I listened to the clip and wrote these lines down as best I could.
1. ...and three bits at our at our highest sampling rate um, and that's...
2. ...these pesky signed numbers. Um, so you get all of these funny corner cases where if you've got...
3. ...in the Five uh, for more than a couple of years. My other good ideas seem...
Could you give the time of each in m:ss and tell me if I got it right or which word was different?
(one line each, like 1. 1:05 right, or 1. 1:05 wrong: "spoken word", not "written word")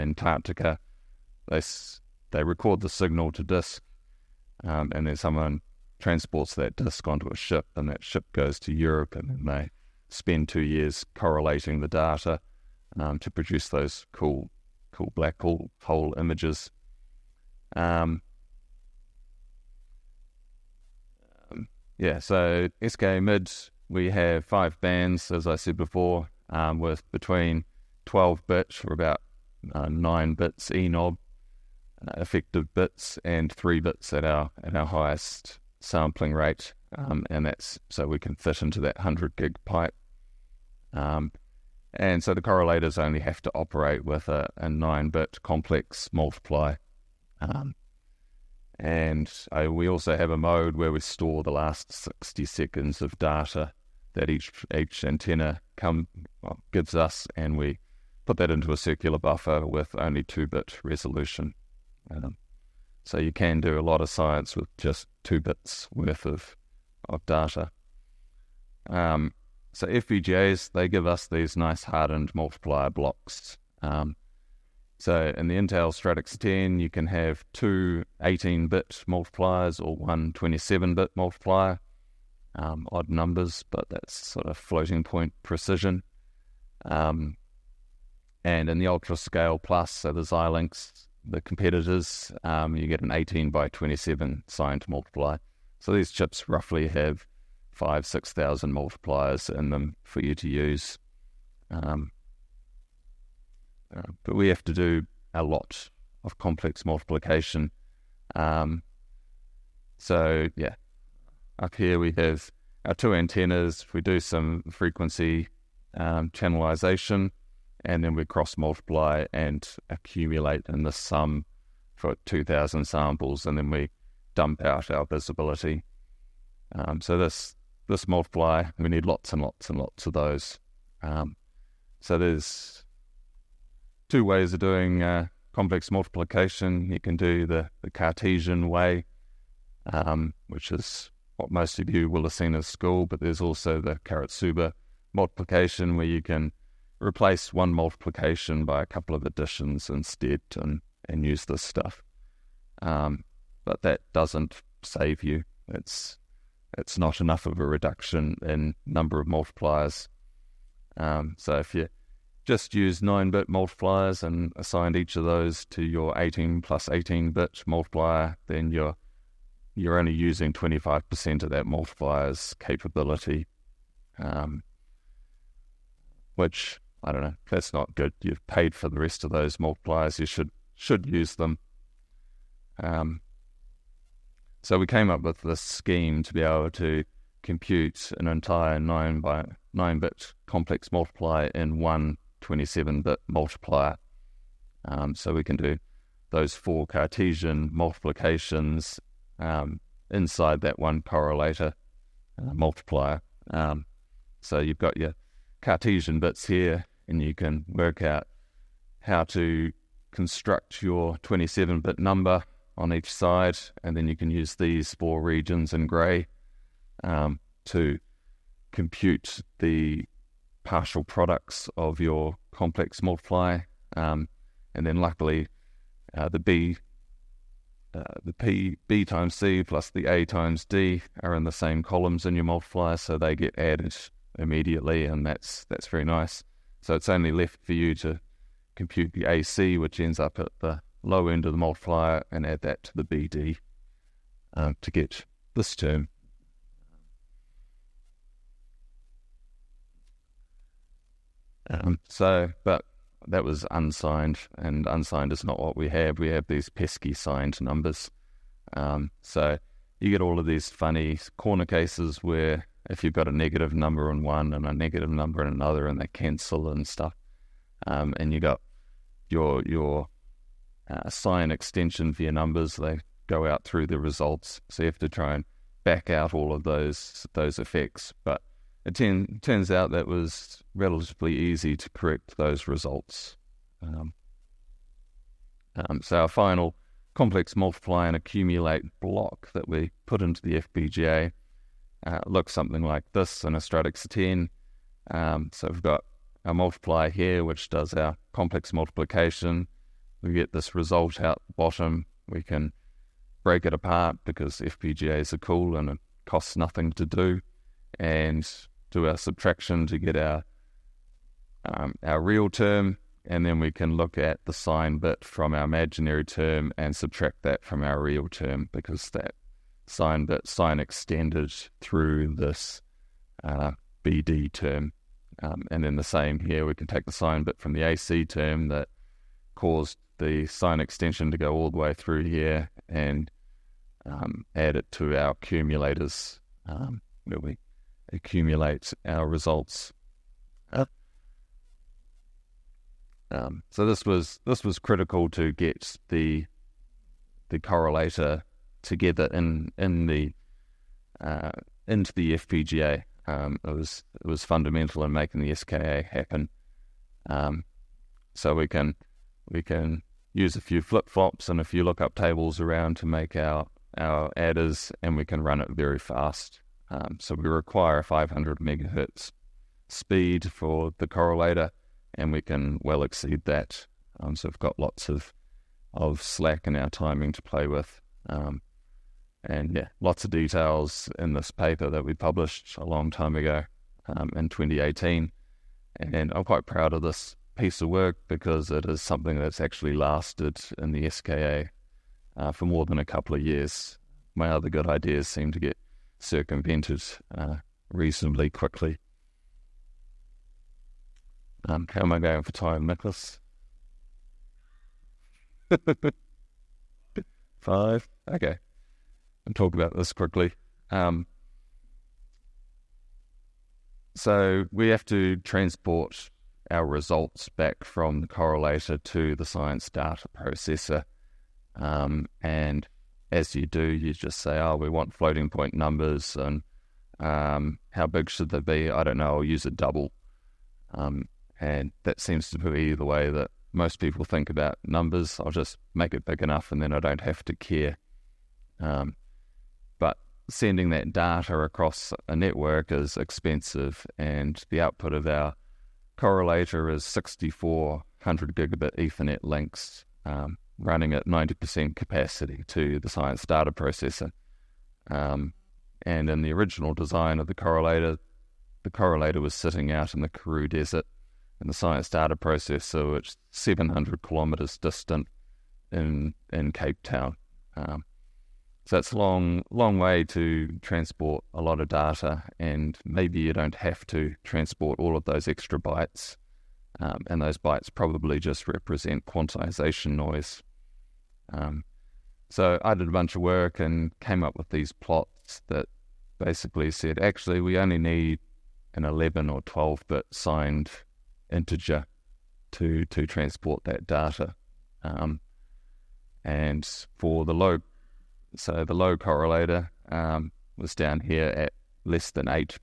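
1. 0:33 right
2. 4:16 right
3. 6:30 wrong: "SKA", not "Five".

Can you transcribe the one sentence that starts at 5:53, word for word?
Um, it was it was fundamental in making the SKA happen.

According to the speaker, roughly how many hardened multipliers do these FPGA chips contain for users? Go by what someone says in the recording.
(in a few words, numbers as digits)
5,000 to 6,000.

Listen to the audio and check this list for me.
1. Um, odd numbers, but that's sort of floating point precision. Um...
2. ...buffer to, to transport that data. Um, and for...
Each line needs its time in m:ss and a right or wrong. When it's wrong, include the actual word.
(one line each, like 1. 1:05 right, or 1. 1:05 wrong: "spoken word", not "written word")
1. 1:22 right
2. 8:11 wrong: "integer", not "buffer".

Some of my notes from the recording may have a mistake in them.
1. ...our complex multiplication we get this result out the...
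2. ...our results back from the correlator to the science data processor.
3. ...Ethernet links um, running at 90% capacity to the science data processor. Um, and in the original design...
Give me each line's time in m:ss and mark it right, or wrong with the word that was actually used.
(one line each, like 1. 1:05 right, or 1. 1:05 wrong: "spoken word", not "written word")
1. 4:57 right
2. 6:56 right
3. 7:28 right.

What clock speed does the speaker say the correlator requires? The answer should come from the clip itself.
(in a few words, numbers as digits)
500 MHz.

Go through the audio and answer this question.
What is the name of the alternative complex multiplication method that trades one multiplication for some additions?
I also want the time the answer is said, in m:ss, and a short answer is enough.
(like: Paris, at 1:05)
Karatsuba multiplication, at 2:24.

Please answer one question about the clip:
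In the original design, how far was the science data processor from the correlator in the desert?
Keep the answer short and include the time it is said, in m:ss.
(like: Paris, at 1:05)
700 km, at 7:43.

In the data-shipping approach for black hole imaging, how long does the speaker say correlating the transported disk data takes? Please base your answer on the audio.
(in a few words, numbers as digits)
2 years.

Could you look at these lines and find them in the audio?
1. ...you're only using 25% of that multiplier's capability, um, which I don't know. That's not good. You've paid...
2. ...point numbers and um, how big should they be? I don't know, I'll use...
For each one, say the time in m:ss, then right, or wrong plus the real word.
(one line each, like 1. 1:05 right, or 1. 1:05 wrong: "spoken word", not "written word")
1. 2:49 right
2. 7:05 right.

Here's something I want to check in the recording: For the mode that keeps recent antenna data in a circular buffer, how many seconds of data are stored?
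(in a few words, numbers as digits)
60 seconds.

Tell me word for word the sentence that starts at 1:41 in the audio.
Um, uh, but we have to do a lot of complex multiplication.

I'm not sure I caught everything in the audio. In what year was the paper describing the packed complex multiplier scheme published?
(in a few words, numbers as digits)
2018.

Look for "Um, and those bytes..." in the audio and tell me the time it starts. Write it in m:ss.
7:57.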